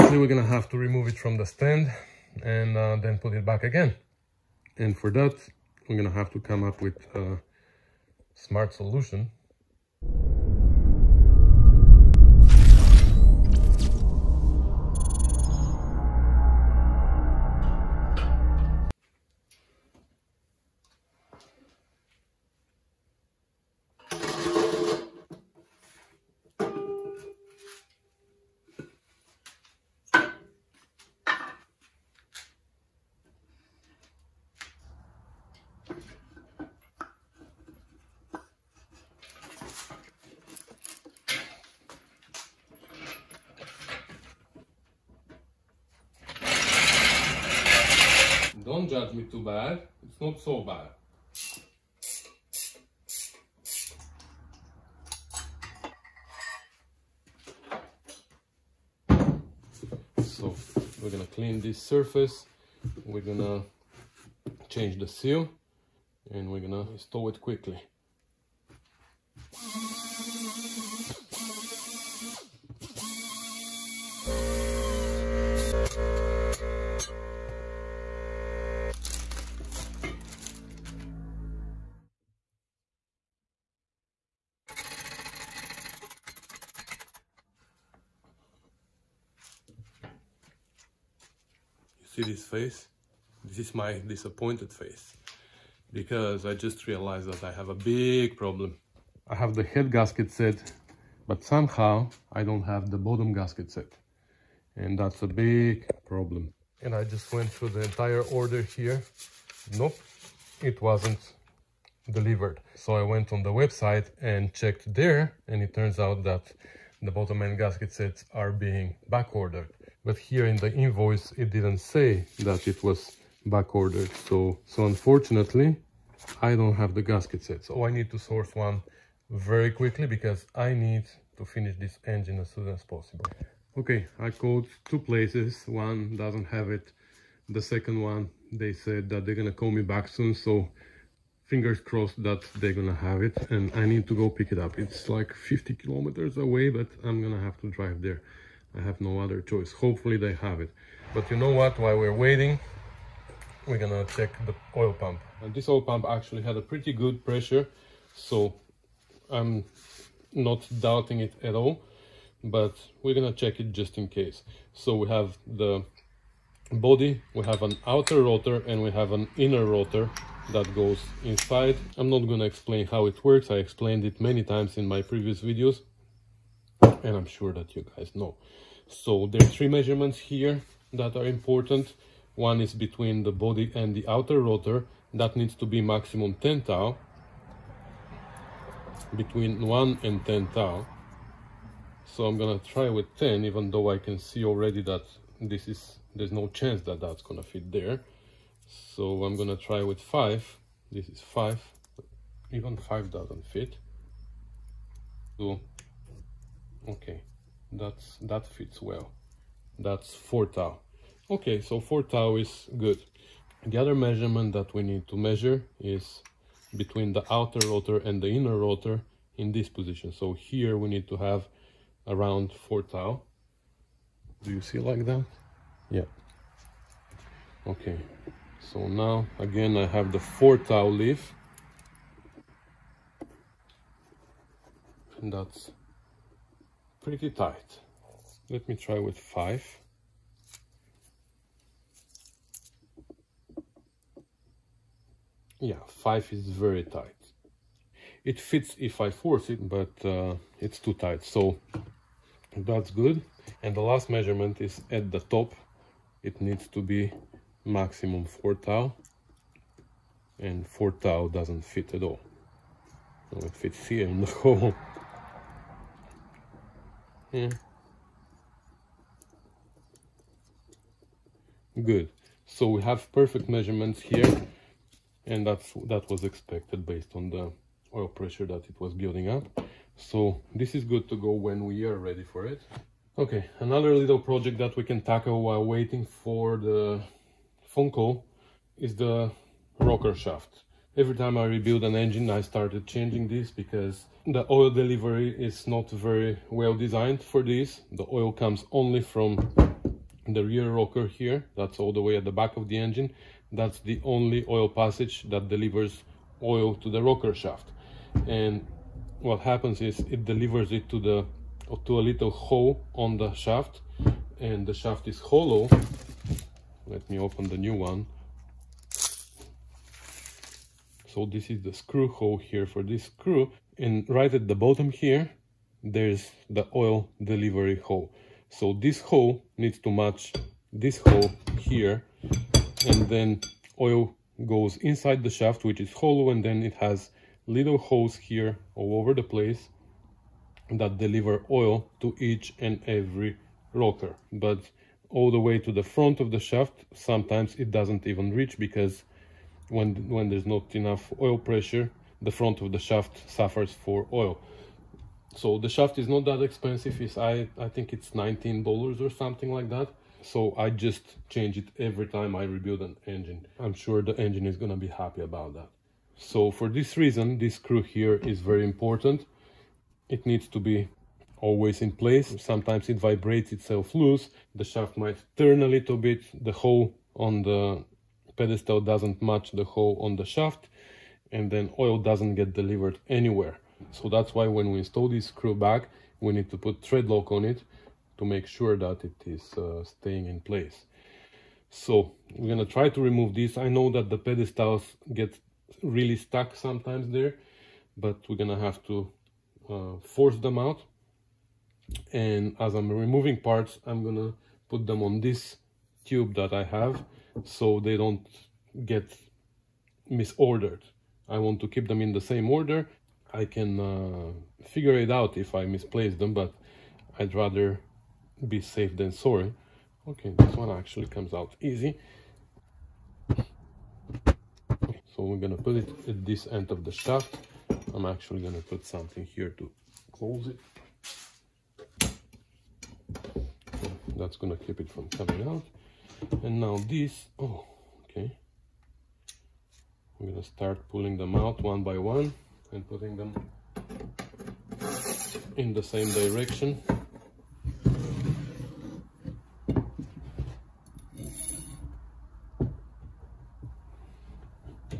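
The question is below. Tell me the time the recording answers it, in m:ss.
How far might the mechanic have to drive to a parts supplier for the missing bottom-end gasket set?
2:25.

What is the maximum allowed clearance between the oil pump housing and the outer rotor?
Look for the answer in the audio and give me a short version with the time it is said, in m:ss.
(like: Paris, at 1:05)
10 thou, at 3:05.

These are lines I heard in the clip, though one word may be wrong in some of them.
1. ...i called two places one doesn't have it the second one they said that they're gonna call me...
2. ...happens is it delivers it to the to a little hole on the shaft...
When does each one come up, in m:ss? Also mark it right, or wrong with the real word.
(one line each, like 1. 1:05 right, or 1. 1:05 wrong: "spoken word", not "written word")
1. 2:14 right
2. 5:09 right.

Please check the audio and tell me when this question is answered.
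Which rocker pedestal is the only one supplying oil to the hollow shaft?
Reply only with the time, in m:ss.
5:00.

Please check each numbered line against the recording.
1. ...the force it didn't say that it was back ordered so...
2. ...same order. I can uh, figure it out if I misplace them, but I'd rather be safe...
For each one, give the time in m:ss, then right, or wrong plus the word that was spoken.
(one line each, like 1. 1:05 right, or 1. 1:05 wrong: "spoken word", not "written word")
1. 2:00 wrong: "invoice", not "force"
2. 6:52 right.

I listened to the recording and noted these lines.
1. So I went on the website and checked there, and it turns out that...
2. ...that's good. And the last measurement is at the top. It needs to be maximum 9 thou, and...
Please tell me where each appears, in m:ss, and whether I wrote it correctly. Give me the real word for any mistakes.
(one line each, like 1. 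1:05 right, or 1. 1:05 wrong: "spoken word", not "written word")
1. 1:52 right
2. 4:12 wrong: "4", not "9".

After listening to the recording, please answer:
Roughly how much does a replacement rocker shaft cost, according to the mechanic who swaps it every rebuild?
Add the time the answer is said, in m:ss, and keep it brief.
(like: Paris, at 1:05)
$19, at 5:58.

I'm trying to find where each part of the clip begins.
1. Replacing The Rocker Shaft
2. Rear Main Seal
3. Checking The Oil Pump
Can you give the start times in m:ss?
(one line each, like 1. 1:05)
1. 4:42
2. 0:59
3. 2:32.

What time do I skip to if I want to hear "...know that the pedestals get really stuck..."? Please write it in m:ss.
6:33.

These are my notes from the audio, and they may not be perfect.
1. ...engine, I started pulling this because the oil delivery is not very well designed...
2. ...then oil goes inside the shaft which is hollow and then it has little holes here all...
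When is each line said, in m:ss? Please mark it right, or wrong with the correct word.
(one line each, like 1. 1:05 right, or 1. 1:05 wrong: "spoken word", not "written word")
1. 4:51 wrong: "changing", not "pulling"
2. 5:33 right.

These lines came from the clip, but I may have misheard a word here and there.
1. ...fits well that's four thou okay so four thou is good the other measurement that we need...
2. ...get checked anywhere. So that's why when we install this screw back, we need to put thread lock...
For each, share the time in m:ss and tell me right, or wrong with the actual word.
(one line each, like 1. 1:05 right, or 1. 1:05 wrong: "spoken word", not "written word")
1. 3:28 right
2. 6:22 wrong: "delivered", not "checked".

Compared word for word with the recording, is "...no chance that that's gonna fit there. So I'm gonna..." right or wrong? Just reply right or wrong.
right.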